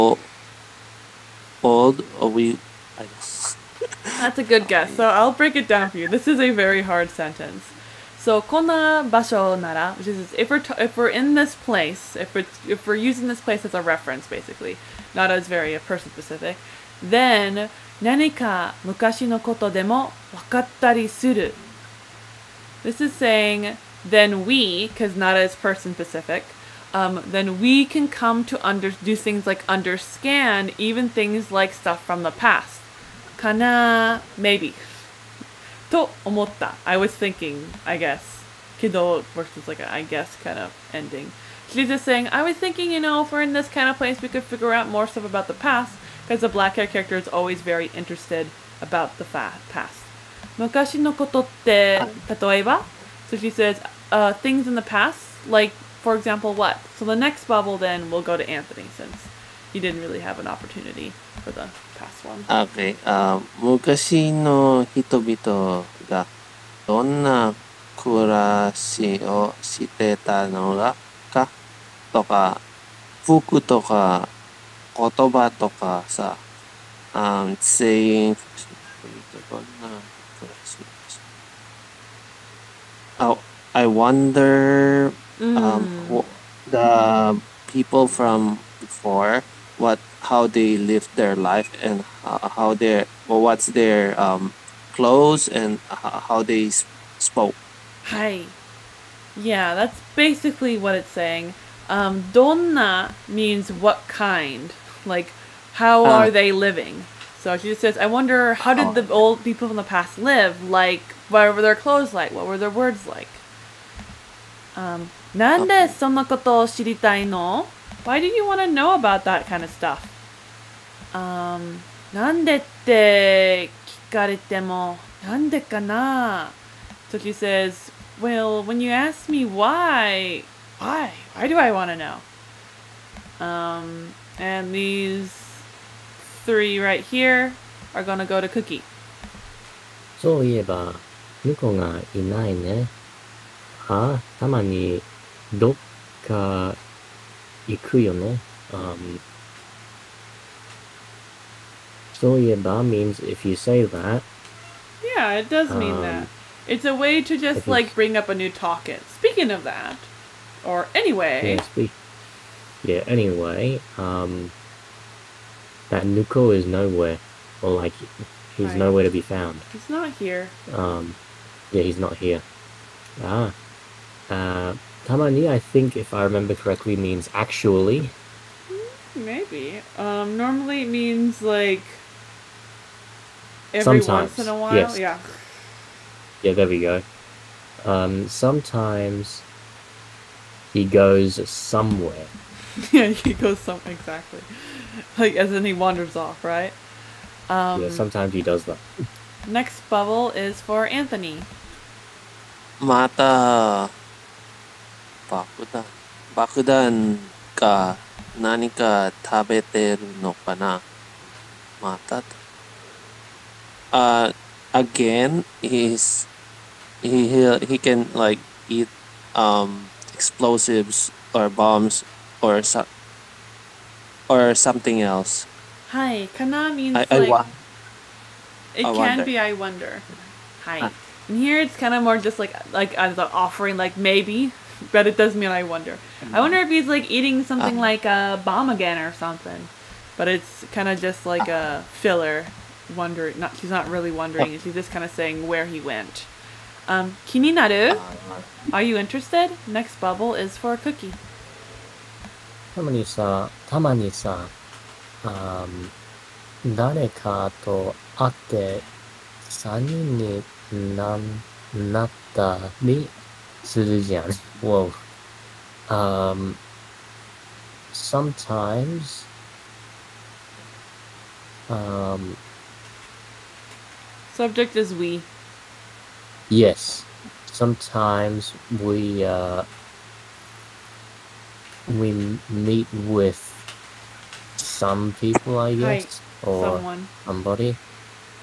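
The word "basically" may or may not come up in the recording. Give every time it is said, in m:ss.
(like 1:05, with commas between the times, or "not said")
0:14, 1:40.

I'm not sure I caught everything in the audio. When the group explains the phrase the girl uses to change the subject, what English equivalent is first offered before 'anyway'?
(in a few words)
Speaking of that.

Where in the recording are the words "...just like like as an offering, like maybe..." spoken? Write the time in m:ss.
3:52.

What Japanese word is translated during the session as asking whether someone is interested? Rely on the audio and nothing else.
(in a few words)
Kininaru.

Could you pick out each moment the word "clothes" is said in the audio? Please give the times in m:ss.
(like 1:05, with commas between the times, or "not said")
1:34, 1:51.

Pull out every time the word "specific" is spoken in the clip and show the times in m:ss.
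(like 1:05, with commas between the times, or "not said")
0:16, 0:25.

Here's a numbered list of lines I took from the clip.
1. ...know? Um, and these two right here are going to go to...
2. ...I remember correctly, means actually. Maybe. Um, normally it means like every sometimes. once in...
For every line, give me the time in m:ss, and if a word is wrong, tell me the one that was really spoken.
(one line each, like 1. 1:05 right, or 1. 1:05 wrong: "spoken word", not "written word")
1. 2:11 wrong: "three", not "two"
2. 2:56 right.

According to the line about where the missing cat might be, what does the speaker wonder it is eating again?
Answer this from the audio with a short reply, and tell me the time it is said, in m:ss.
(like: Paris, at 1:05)
Bombs, at 3:41.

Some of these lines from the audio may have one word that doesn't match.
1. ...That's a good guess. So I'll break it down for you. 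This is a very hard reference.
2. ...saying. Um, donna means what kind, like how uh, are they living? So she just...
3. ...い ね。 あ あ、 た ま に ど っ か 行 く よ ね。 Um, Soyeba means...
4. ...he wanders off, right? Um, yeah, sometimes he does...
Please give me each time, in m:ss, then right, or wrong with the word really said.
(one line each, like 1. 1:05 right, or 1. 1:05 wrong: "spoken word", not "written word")
1. 0:04 wrong: "sentence", not "reference"
2. 1:41 right
3. 2:22 right
4. 3:15 right.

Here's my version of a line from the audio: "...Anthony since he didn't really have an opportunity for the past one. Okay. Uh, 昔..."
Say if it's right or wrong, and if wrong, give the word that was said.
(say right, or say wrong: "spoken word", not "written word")
right.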